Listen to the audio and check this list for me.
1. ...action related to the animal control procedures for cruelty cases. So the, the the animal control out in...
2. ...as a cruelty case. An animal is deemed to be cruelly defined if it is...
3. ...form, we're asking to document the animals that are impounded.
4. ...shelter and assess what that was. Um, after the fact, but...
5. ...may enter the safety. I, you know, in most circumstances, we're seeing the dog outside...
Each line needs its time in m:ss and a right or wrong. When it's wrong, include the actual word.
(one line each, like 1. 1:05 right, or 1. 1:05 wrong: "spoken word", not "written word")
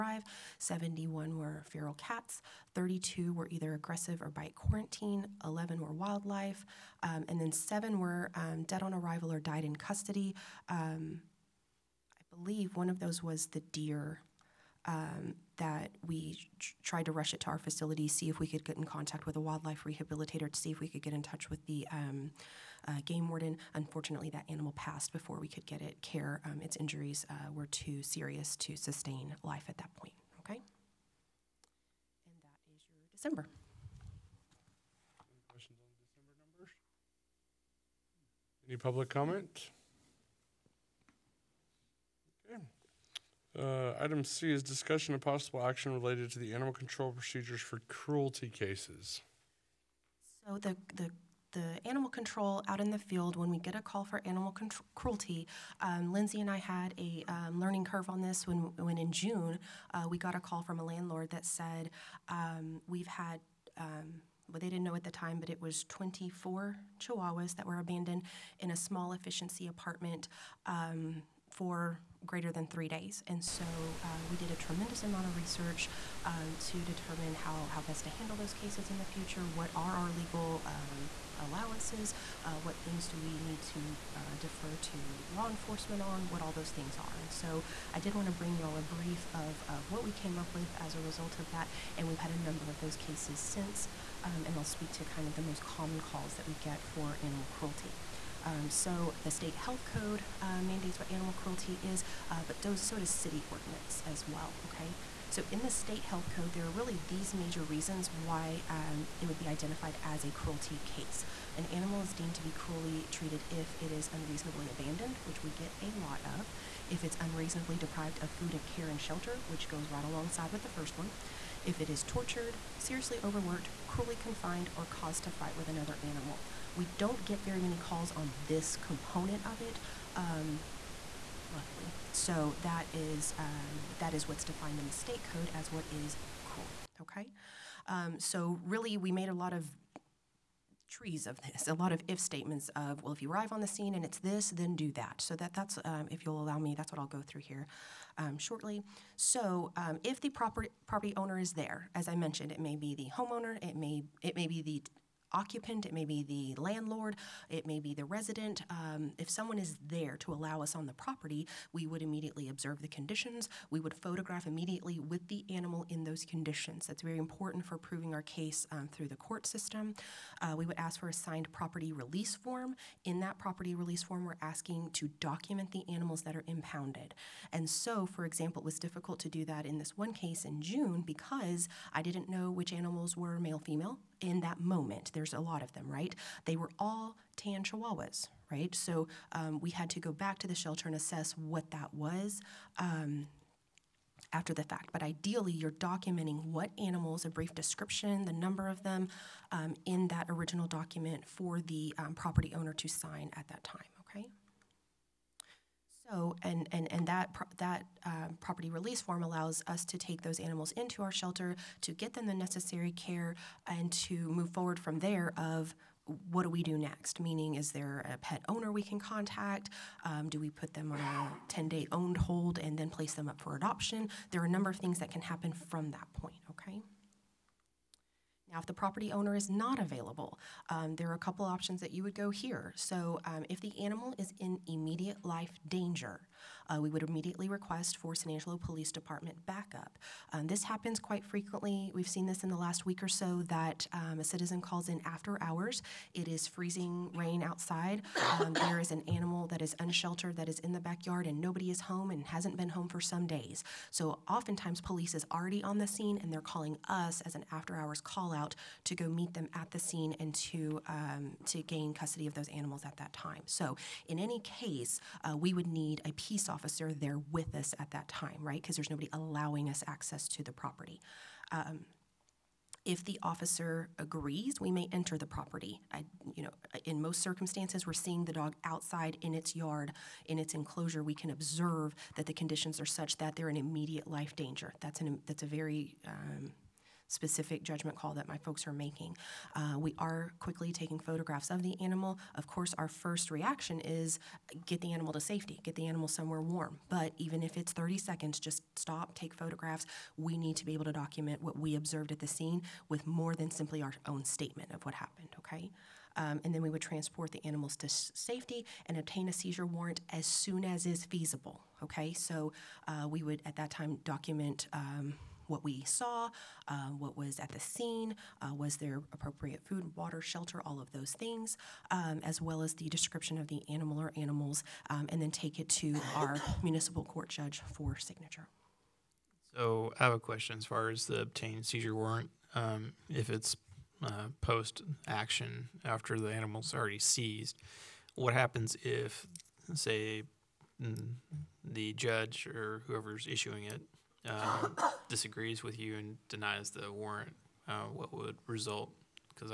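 1. 0:45 right
2. 1:50 wrong: "treated", not "defined"
3. 2:54 right
4. 3:10 right
5. 4:34 wrong: "property", not "safety".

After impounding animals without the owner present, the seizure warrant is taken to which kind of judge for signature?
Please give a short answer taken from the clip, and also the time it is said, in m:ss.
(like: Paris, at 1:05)
Municipal court judge, at 5:26.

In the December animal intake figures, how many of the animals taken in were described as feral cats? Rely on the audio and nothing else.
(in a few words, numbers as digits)
71.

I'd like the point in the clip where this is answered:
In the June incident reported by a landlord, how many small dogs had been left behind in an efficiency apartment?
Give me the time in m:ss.
1:05.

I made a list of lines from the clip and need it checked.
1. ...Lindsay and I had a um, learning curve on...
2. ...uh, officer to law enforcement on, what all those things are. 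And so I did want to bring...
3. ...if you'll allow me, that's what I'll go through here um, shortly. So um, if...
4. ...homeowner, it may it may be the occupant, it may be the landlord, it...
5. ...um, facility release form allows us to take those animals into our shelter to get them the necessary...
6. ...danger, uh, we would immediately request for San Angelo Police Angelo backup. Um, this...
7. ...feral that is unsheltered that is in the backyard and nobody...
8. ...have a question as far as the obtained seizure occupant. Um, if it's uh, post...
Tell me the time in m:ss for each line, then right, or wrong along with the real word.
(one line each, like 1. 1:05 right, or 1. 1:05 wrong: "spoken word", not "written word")
1. 0:56 right
2. 1:24 wrong: "defer", not "officer"
3. 2:26 right
4. 2:33 right
5. 3:28 wrong: "property", not "facility"
6. 3:55 wrong: "Department", not "Angelo"
7. 4:09 wrong: "animal", not "feral"
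8. 5:30 wrong: "warrant", not "occupant".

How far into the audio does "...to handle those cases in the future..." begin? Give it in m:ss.
1:18.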